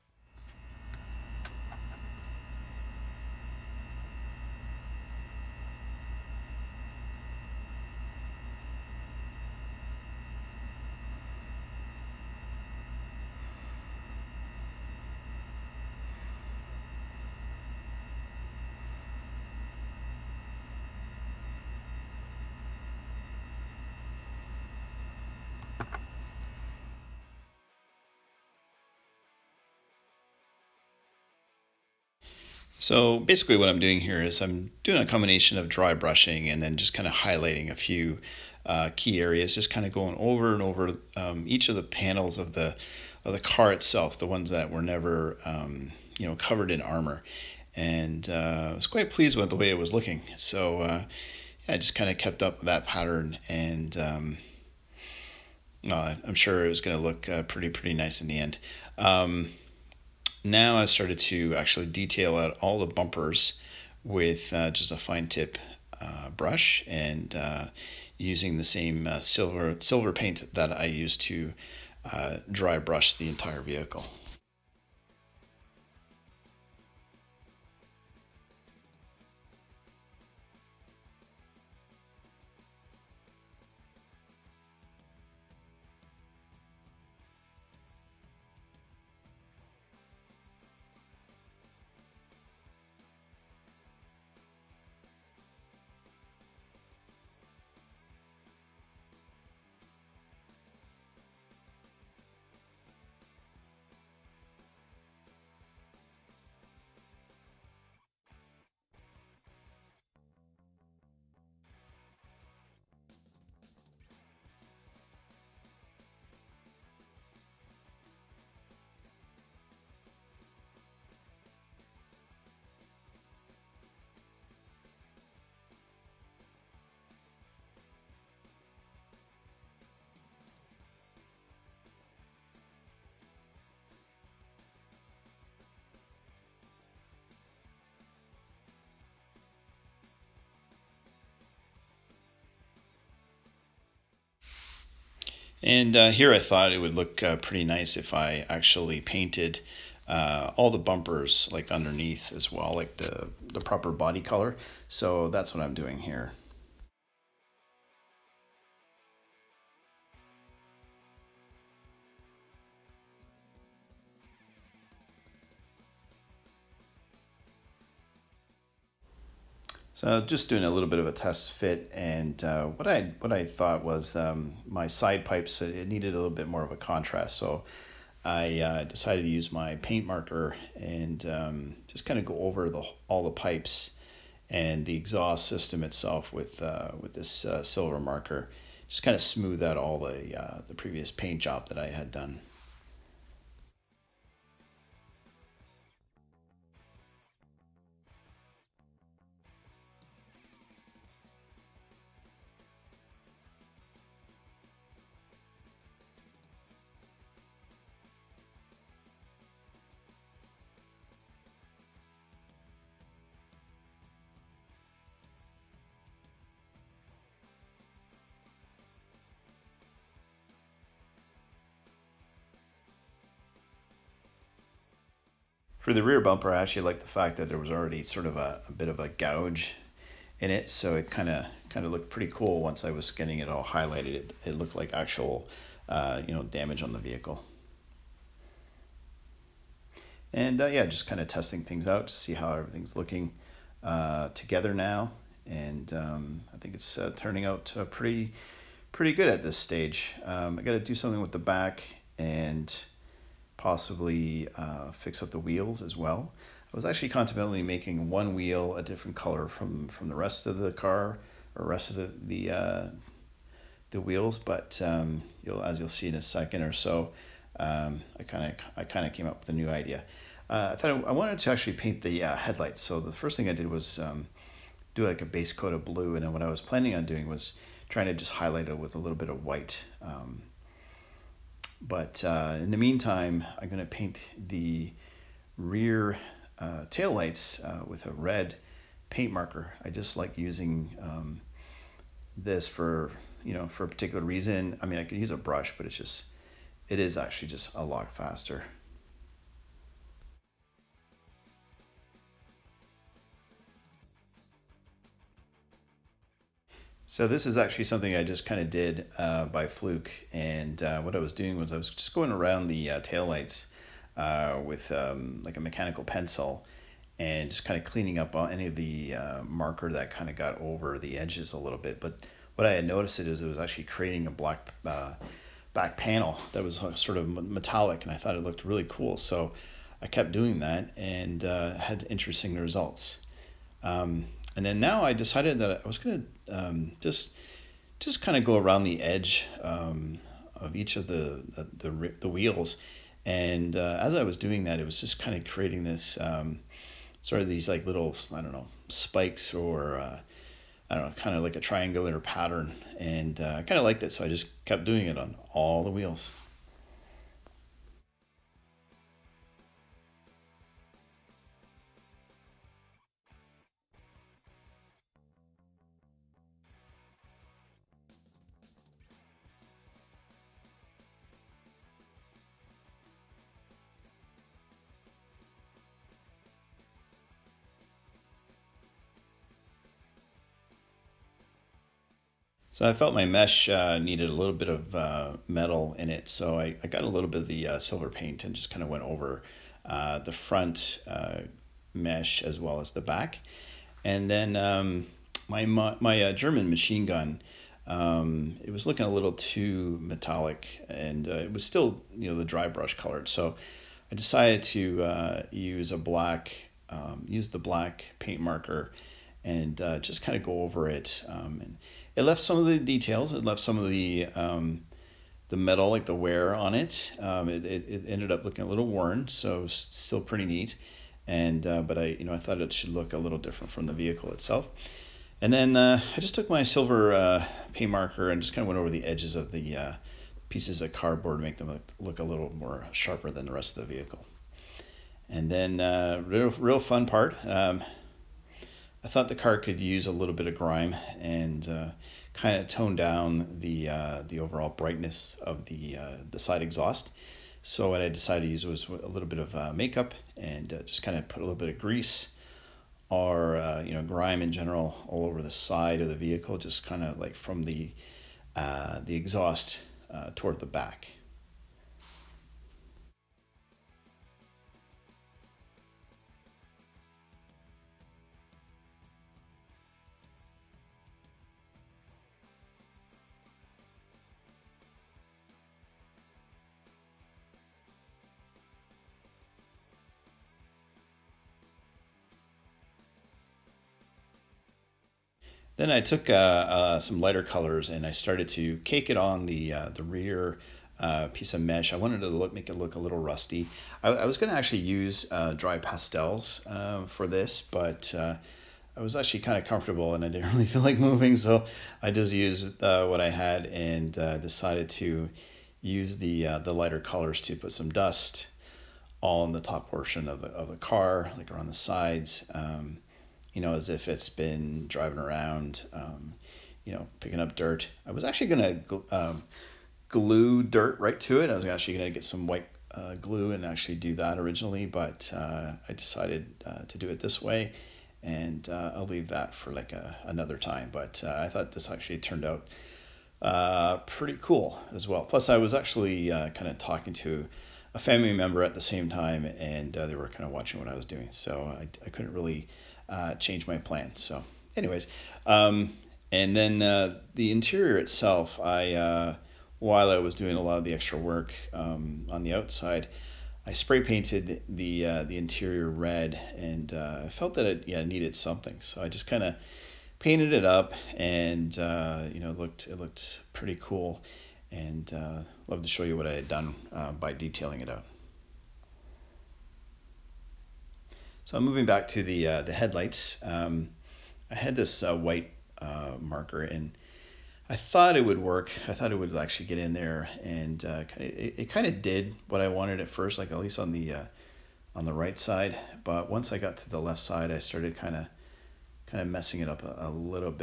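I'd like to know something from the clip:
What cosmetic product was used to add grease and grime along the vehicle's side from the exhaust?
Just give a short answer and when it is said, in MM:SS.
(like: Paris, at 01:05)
makeup, at 07:29.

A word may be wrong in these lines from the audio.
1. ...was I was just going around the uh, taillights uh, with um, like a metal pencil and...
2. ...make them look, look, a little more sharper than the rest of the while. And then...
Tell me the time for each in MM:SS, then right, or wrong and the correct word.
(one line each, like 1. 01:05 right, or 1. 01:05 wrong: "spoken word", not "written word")
1. 05:11 wrong: "mechanical", not "metal"
2. 07:11 wrong: "vehicle", not "while".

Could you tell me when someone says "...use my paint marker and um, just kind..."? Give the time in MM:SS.
02:59.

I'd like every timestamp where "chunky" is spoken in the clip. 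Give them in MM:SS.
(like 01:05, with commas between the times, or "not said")
not said.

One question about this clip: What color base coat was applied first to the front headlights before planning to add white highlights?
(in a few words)
blue.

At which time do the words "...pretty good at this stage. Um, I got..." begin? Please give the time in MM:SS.
04:08.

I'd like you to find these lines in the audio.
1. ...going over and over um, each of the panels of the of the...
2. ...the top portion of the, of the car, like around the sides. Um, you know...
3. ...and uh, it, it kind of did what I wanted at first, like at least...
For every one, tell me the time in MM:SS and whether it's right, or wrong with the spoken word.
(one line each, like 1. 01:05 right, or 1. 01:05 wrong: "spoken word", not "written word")
1. 00:39 right
2. 08:29 right
3. 09:40 right.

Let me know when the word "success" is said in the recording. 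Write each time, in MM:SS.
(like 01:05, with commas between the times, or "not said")
not said.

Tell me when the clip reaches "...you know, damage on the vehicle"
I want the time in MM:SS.
03:56.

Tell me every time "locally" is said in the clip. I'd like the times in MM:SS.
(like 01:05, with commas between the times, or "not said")
not said.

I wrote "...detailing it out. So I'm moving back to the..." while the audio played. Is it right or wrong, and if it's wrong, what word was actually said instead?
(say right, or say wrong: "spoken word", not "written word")
right.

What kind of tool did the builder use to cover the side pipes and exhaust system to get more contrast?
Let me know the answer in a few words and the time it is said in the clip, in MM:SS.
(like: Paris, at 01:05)
silver marker, at 03:07.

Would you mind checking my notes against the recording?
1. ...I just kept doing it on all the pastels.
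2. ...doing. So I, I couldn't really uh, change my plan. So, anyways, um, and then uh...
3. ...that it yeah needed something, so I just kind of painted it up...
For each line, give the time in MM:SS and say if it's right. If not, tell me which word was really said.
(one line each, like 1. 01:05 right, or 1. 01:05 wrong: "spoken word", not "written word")
1. 05:54 wrong: "wheels", not "pastels"
2. 09:01 right
3. 09:17 right.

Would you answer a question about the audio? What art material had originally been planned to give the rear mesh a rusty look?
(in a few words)
dry pastels.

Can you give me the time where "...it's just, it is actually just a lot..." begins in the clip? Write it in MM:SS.
04:55.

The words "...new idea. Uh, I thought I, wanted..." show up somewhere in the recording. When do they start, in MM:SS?
04:29.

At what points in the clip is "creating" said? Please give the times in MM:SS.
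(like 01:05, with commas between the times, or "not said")
05:23, 05:45.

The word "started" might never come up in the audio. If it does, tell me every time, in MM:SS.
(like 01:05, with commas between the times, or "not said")
01:00, 08:08, 09:47.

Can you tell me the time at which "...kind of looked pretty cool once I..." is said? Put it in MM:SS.
03:51.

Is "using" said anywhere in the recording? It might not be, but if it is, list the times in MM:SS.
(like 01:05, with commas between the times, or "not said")
01:08, 04:50.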